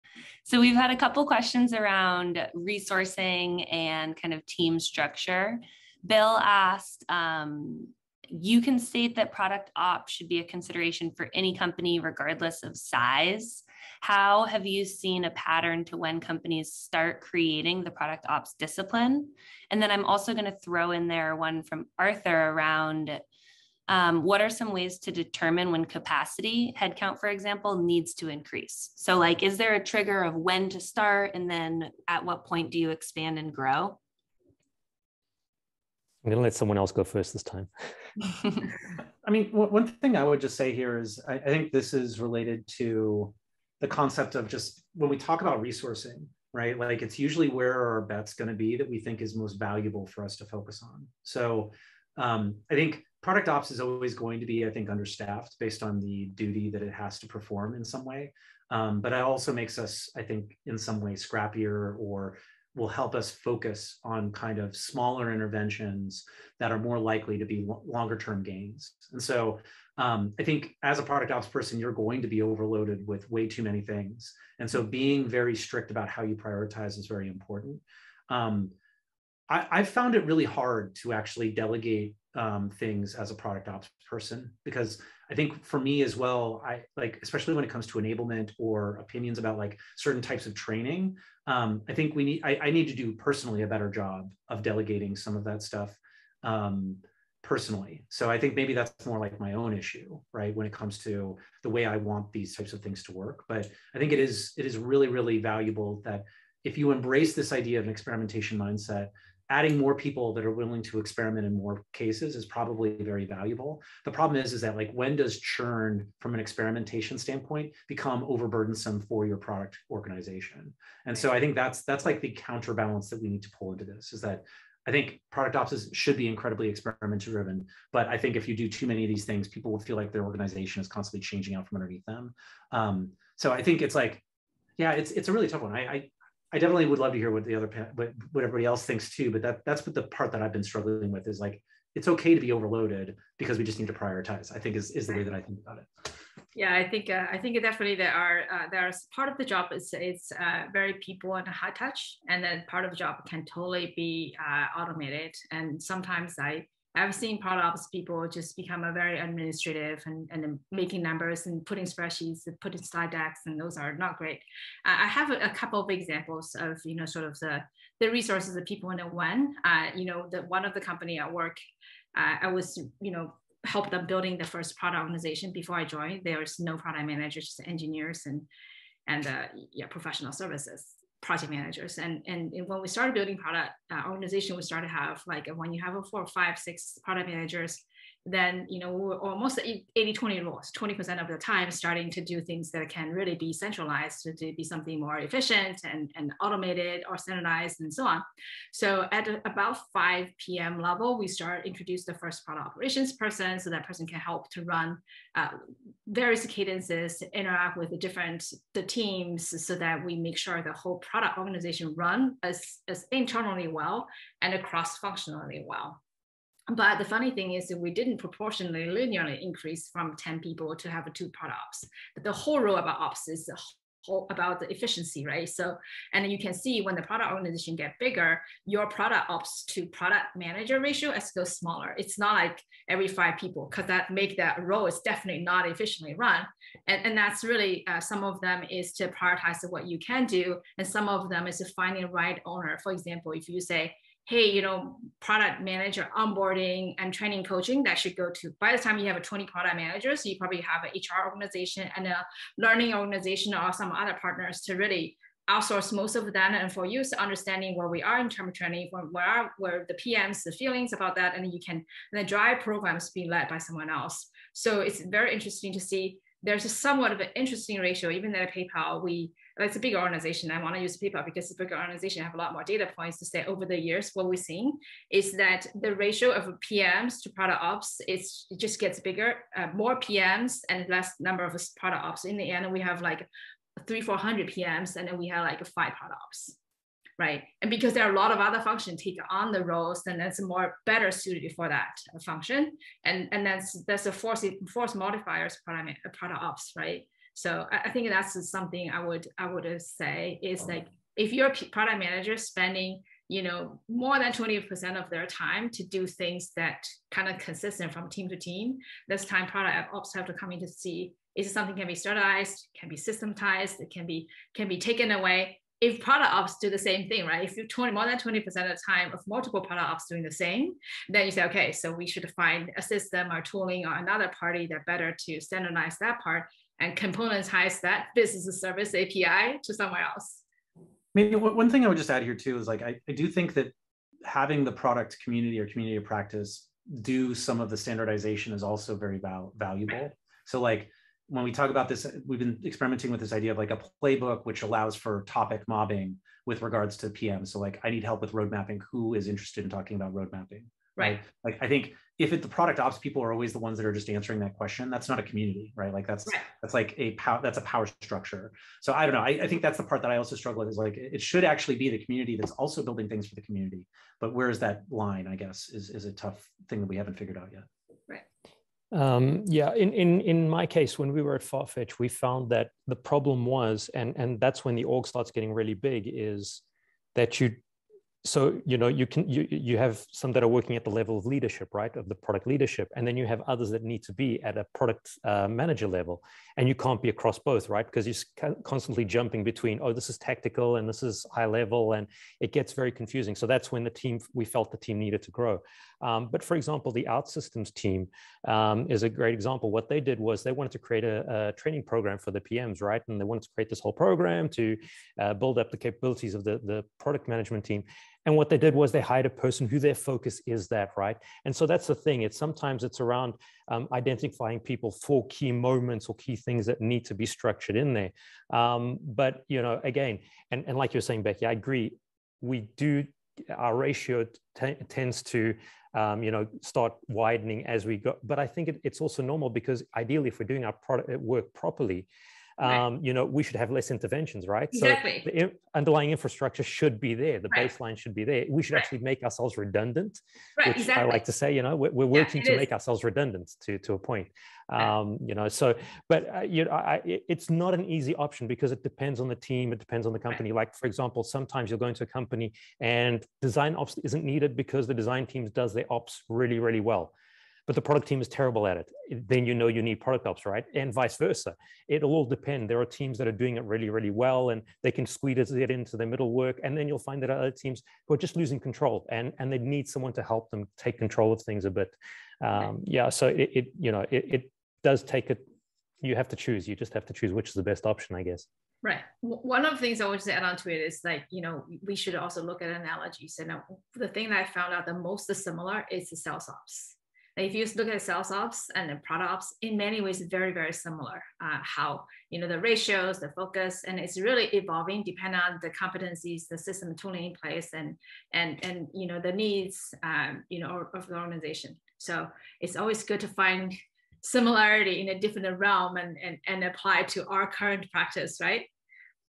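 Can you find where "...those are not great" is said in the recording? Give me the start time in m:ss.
2:43.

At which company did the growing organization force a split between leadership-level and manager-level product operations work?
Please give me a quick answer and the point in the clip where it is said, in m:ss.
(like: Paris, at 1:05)
Farfetch, at 6:11.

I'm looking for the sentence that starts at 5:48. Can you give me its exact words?
Who is interested in talking about road mapping?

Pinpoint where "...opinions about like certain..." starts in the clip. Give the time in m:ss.
1:28.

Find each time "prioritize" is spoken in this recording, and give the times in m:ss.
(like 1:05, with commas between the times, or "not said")
1:16, 2:23, 3:59.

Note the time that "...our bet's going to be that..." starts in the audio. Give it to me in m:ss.
0:47.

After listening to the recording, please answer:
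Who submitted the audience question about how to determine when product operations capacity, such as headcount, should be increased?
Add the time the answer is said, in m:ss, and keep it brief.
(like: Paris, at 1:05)
Arthur, at 0:21.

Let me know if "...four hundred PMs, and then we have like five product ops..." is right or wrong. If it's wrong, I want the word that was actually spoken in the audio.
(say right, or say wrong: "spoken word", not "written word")
right.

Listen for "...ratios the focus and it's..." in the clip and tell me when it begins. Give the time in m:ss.
8:12.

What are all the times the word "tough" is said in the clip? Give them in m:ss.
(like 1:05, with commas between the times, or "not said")
2:15, 6:06.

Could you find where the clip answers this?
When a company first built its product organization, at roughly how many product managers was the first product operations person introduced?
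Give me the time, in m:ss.
3:19.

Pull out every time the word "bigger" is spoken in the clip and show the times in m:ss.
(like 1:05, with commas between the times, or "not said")
3:47, 4:39.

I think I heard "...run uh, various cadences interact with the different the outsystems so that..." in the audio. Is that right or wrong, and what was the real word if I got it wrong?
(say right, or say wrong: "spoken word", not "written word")
wrong: "teams", not "outsystems".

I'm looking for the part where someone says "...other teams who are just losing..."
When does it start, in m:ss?
7:47.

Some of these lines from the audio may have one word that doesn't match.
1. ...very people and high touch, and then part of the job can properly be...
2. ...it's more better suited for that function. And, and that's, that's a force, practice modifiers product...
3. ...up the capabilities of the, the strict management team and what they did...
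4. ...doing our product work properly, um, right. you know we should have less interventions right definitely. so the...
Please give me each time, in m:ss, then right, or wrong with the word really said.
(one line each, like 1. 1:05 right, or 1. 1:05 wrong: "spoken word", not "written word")
1. 2:30 wrong: "totally", not "properly"
2. 4:50 wrong: "force", not "practice"
3. 6:45 wrong: "product", not "strict"
4. 7:10 wrong: "exactly", not "definitely".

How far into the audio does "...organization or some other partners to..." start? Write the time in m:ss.
4:12.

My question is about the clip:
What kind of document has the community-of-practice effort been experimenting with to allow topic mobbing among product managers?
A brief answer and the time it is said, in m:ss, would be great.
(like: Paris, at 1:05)
playbook, at 5:44.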